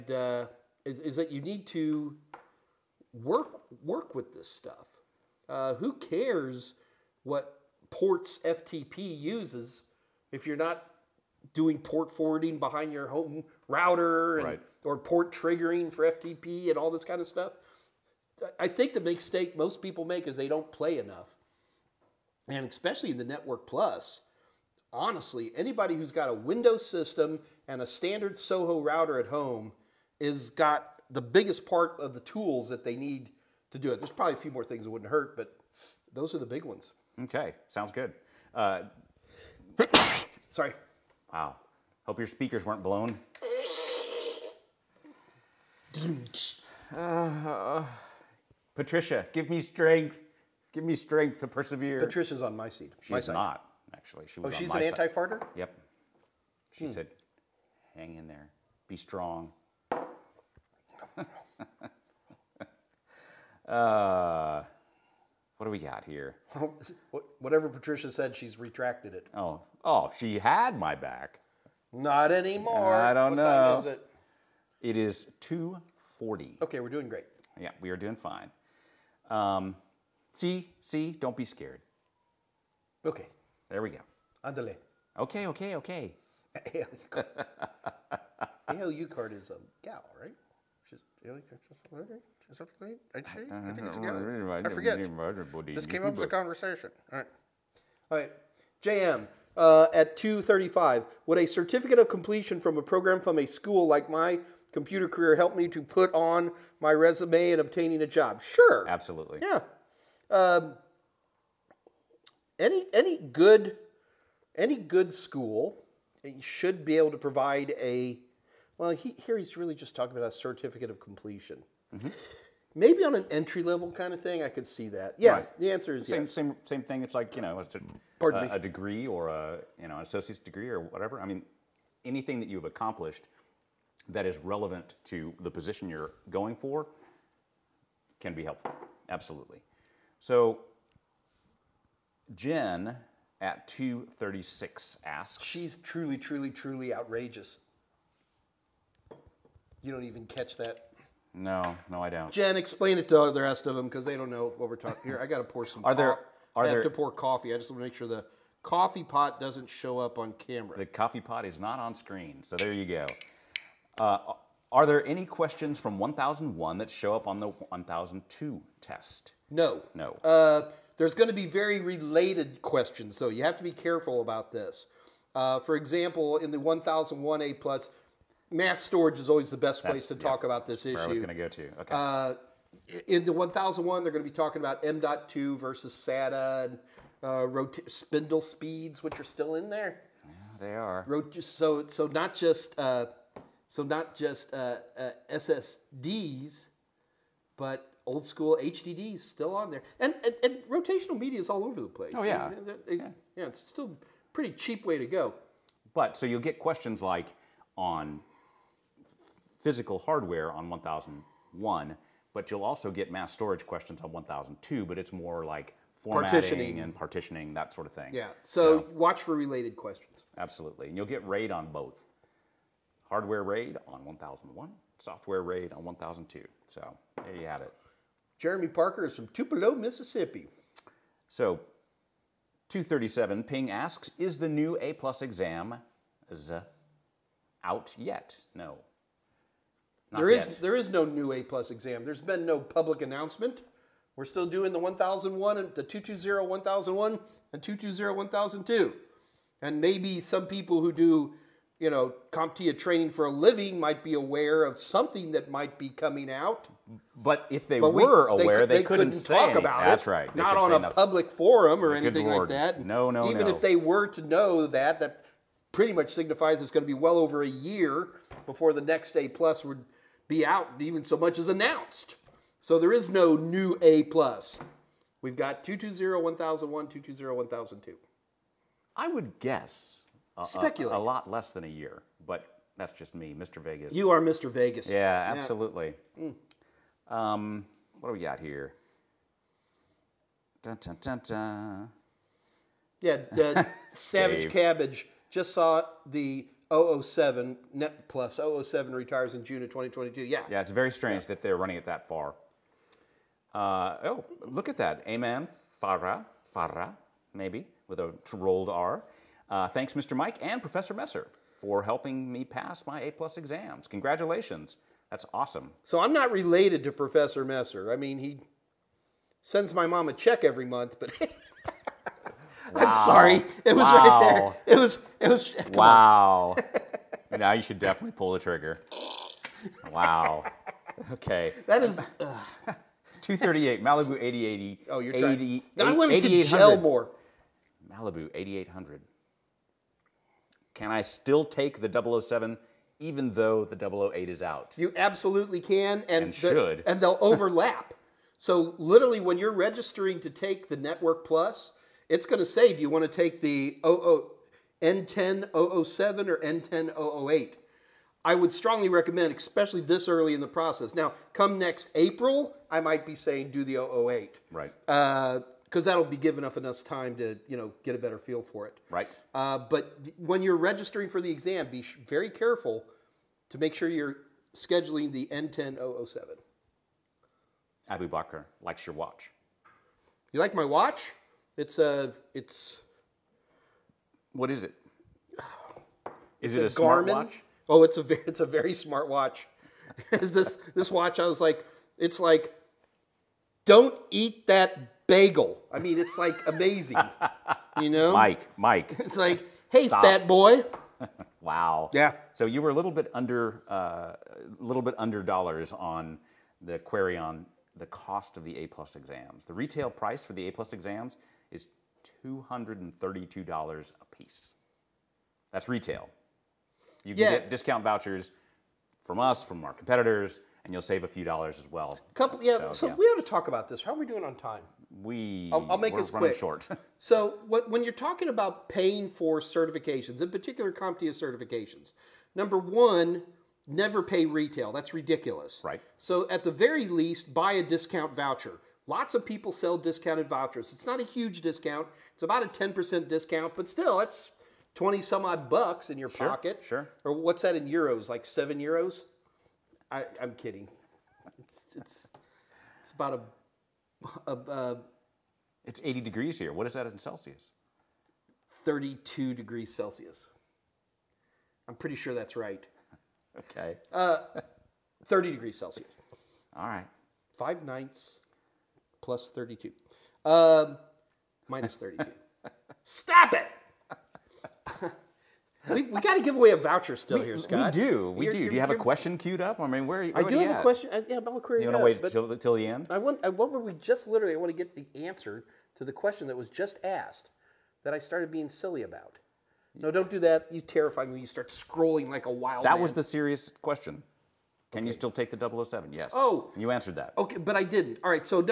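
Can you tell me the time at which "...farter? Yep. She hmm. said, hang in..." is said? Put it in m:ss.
0:55.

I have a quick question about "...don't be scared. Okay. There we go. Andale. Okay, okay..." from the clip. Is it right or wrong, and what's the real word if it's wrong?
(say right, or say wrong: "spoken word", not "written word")
right.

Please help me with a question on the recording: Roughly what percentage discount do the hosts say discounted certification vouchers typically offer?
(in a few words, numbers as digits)
10%.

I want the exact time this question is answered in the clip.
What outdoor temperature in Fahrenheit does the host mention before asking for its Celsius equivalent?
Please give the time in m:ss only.
7:35.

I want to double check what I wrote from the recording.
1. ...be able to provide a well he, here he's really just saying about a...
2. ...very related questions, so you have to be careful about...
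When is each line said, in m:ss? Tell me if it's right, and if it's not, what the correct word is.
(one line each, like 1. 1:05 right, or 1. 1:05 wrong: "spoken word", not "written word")
1. 1:56 wrong: "talking", not "saying"
2. 2:51 right.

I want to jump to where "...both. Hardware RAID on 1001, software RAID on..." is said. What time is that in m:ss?
3:41.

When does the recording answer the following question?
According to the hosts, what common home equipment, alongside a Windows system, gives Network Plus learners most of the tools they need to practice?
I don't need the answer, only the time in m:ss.
0:27.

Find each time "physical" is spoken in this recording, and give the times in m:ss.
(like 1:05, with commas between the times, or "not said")
3:29.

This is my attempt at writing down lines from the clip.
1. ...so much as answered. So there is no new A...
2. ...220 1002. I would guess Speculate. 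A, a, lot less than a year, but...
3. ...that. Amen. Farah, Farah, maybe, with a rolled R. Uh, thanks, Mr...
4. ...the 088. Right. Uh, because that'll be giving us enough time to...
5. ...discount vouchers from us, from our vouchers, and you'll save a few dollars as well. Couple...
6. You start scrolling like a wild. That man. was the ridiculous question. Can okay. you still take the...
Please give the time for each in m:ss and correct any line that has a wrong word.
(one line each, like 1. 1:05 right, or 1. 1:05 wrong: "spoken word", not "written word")
1. 4:31 wrong: "announced", not "answered"
2. 4:36 right
3. 5:04 right
4. 6:03 wrong: "008", not "088"
5. 6:57 wrong: "competitors", not "vouchers"
6. 8:11 wrong: "serious", not "ridiculous".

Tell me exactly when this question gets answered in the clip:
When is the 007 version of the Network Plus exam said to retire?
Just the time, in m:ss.
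4:59.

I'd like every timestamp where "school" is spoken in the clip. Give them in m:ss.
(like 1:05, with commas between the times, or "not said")
1:43, 1:55, 3:18.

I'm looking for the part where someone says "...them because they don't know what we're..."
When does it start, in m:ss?
2:33.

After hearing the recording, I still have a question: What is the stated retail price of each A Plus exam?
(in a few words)
$232.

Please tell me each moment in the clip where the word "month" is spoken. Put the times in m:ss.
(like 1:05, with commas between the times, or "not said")
5:20.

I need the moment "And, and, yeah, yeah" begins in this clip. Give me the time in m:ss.
3:22.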